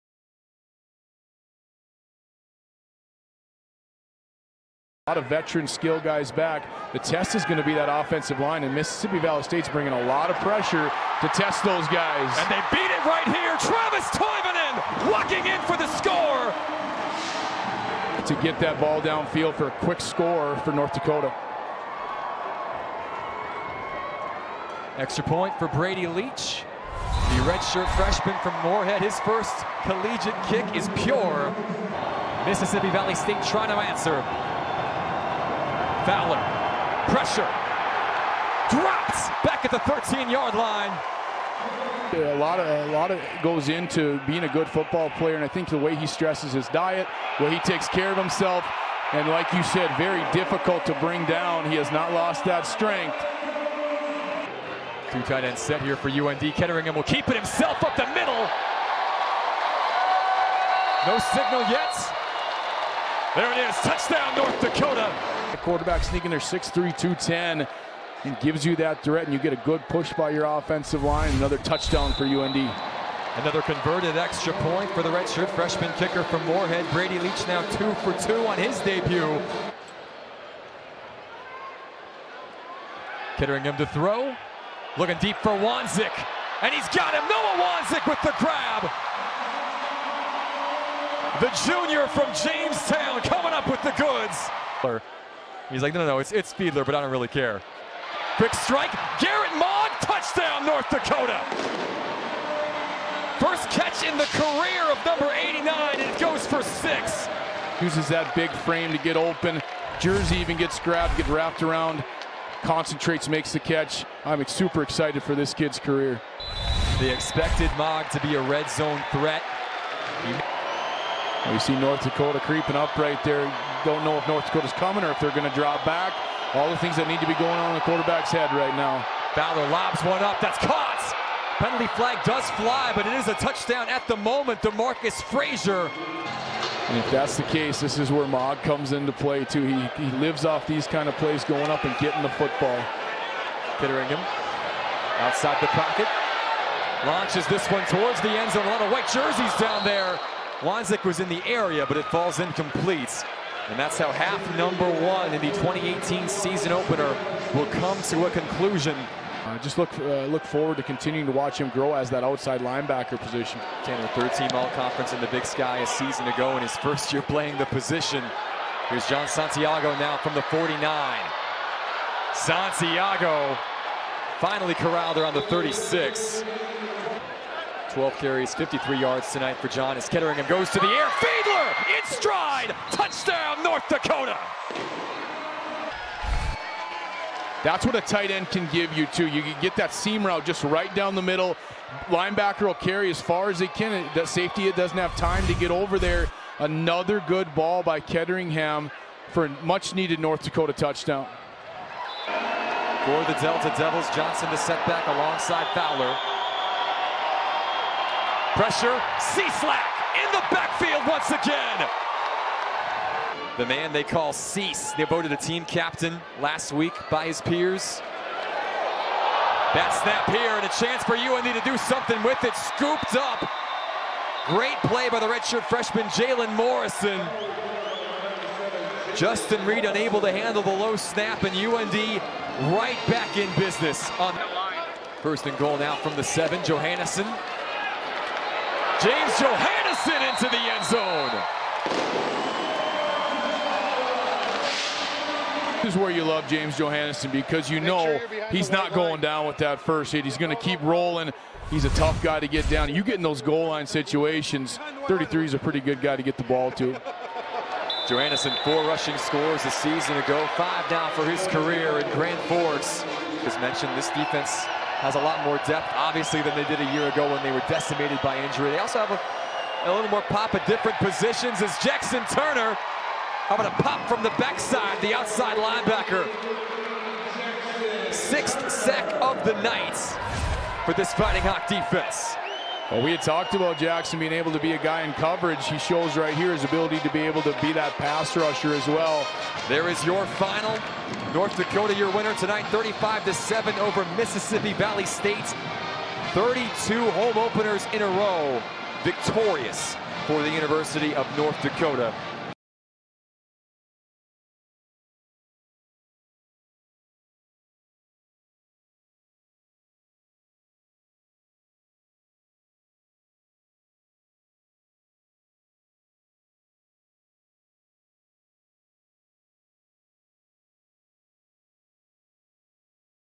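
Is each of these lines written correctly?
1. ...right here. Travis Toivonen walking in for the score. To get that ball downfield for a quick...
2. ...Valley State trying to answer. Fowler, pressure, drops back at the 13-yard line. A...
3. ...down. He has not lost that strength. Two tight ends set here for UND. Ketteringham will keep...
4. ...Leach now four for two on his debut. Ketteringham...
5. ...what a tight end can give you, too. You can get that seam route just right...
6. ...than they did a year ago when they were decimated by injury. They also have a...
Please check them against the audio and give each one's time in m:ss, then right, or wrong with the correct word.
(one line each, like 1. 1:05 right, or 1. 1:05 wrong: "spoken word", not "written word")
1. 0:13 right
2. 0:32 right
3. 0:51 right
4. 1:17 wrong: "two", not "four"
5. 3:07 right
6. 4:26 right.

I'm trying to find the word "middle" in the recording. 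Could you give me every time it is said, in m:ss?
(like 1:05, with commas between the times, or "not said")
0:58, 3:11.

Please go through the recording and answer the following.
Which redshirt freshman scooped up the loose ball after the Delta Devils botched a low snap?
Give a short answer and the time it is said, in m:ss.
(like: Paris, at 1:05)
Jalen Morrison, at 3:46.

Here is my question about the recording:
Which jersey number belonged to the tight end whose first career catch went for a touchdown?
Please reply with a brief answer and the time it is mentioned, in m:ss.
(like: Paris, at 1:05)
89, at 1:45.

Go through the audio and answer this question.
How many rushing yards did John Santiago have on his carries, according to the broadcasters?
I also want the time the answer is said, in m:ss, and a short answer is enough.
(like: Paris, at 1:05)
53, at 2:58.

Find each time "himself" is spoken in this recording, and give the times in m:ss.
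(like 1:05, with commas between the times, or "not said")
0:48, 0:57.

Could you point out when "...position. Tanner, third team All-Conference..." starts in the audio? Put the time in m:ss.
2:43.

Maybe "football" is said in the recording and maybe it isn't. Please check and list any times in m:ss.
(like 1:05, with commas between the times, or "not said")
0:44, 2:22.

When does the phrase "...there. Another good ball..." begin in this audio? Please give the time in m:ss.
3:15.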